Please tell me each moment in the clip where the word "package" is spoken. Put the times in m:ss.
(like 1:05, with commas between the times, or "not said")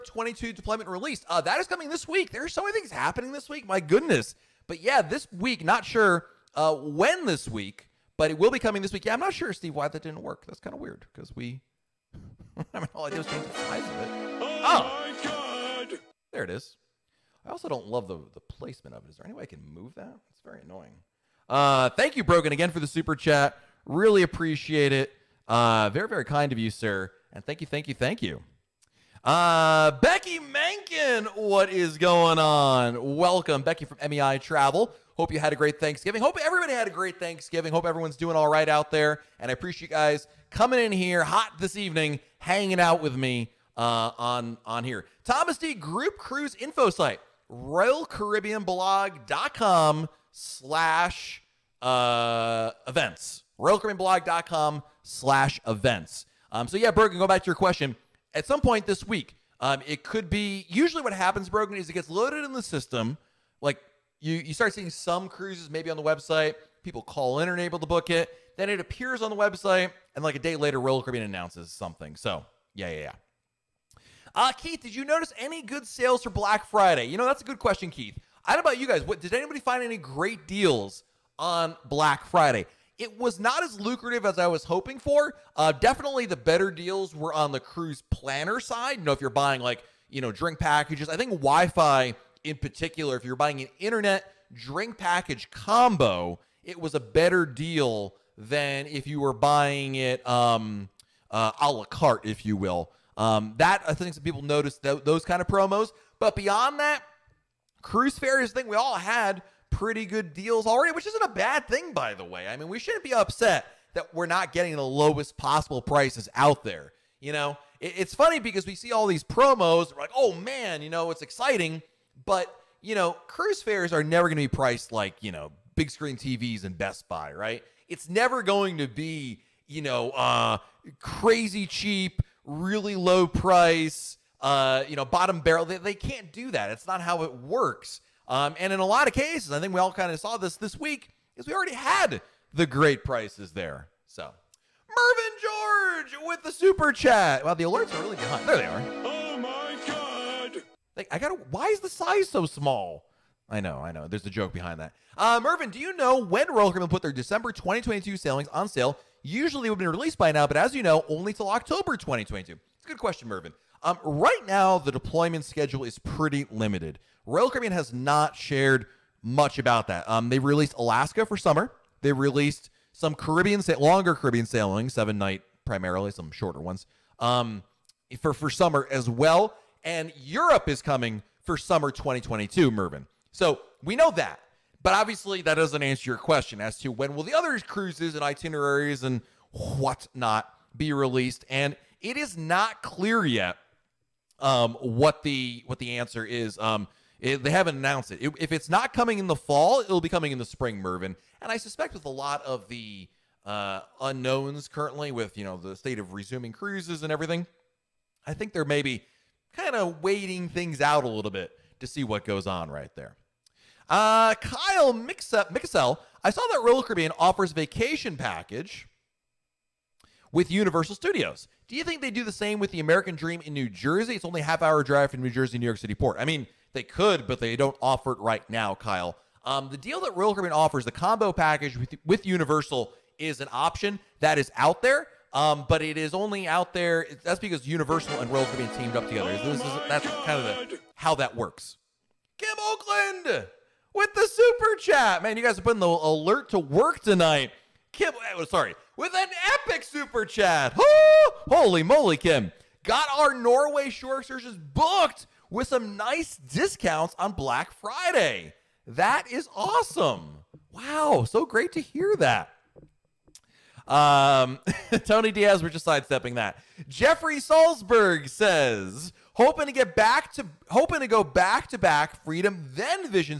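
1:30, 1:34, 3:38, 3:51.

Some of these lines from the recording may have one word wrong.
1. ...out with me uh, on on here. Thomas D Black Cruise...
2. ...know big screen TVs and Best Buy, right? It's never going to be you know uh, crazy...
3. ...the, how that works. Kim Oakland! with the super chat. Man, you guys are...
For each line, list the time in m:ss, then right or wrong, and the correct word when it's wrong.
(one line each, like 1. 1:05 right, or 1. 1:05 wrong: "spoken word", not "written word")
1. 0:42 wrong: "Group", not "Black"
2. 2:05 right
3. 4:00 right.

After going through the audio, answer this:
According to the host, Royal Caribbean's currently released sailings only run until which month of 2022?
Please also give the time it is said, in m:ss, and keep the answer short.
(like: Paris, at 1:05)
October, at 2:41.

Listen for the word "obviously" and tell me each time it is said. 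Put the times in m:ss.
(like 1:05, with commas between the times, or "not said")
3:04.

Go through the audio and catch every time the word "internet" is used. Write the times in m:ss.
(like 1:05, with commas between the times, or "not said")
1:33.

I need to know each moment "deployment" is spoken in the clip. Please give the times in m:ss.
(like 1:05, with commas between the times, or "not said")
0:00, 2:44.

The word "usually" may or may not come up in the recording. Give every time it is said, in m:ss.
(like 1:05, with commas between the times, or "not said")
1:00, 2:39.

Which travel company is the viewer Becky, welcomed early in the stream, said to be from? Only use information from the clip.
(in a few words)
MEI Travel.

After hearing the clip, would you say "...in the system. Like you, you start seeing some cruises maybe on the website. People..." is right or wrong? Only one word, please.
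right.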